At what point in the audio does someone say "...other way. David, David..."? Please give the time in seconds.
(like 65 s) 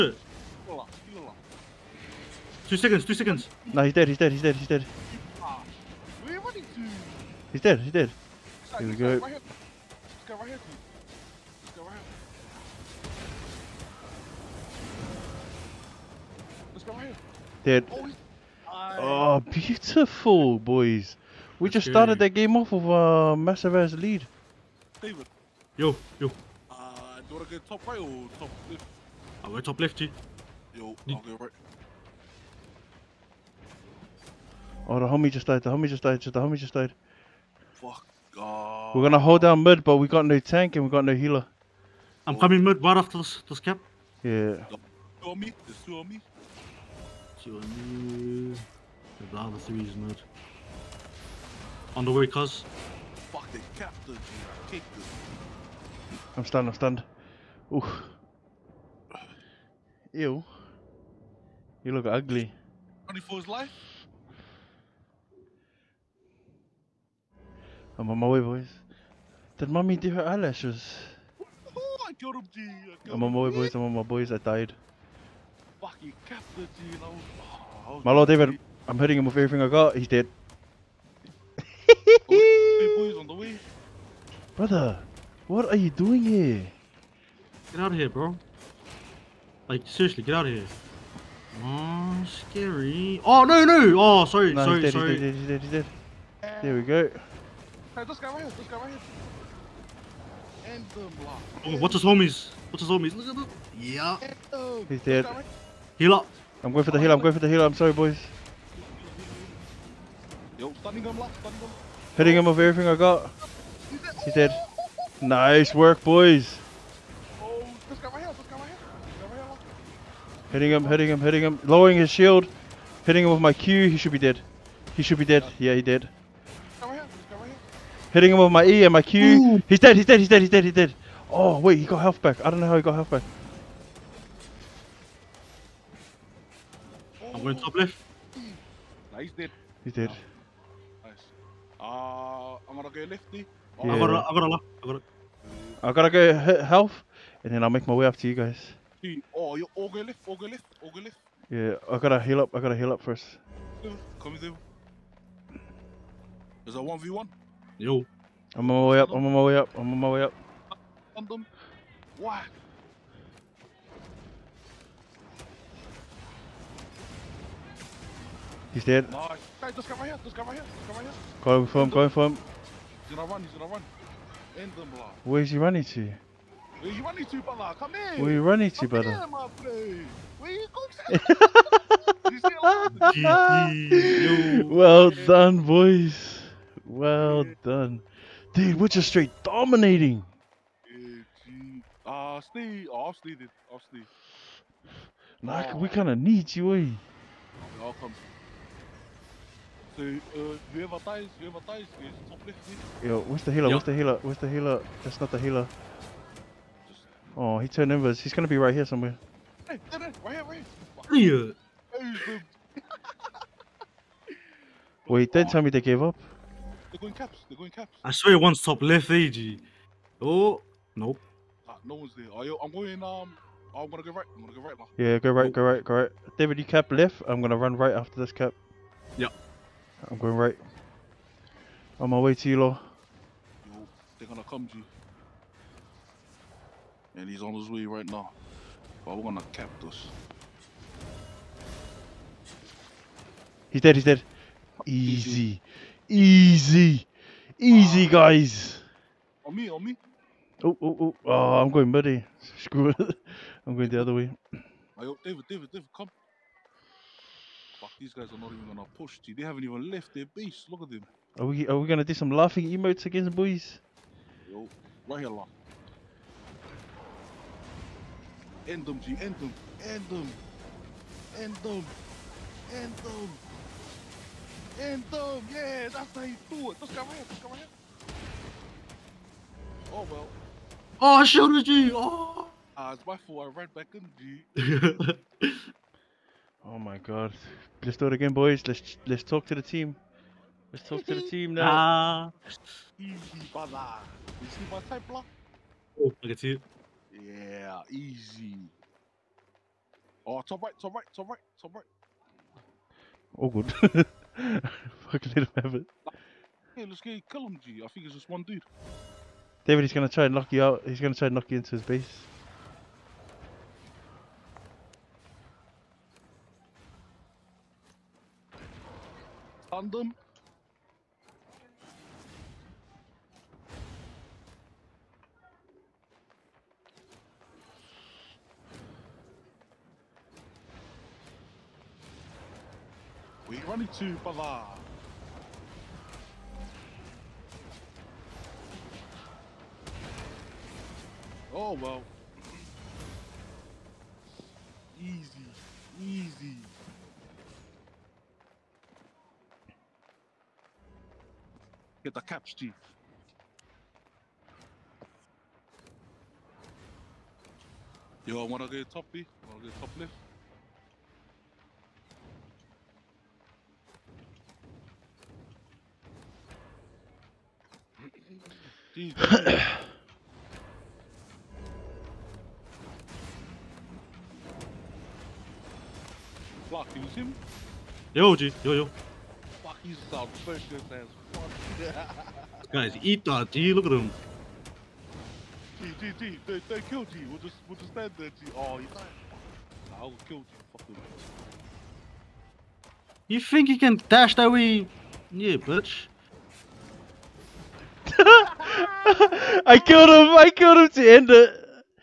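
254 s.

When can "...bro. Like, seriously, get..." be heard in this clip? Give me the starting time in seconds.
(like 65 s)
88 s.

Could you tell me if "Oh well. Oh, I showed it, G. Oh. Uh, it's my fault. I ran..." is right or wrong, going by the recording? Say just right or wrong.
right.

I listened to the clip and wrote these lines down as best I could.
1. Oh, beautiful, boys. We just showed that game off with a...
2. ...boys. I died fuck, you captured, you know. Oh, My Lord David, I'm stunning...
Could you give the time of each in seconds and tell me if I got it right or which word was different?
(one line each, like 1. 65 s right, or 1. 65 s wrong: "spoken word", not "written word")
1. 18 s wrong: "started", not "showed"
2. 74 s wrong: "hitting", not "stunning".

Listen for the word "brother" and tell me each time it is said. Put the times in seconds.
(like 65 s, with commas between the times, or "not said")
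84 s, 177 s, 293 s.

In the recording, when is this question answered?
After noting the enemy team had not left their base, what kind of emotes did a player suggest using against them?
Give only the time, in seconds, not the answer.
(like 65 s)
262 s.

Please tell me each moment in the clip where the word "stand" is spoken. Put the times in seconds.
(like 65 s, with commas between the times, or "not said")
387 s.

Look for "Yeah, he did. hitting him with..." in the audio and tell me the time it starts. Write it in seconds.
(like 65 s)
125 s.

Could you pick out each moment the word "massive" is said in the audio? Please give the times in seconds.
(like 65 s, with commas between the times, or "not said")
23 s.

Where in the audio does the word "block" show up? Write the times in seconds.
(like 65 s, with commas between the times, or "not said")
101 s, 295 s.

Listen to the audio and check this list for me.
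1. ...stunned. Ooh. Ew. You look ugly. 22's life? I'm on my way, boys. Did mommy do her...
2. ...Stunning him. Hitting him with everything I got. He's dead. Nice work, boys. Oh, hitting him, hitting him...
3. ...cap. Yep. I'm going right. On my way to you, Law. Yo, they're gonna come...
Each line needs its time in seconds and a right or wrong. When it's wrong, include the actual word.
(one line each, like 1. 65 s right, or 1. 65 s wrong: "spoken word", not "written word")
1. 56 s wrong: "24", not "22"
2. 111 s right
3. 228 s right.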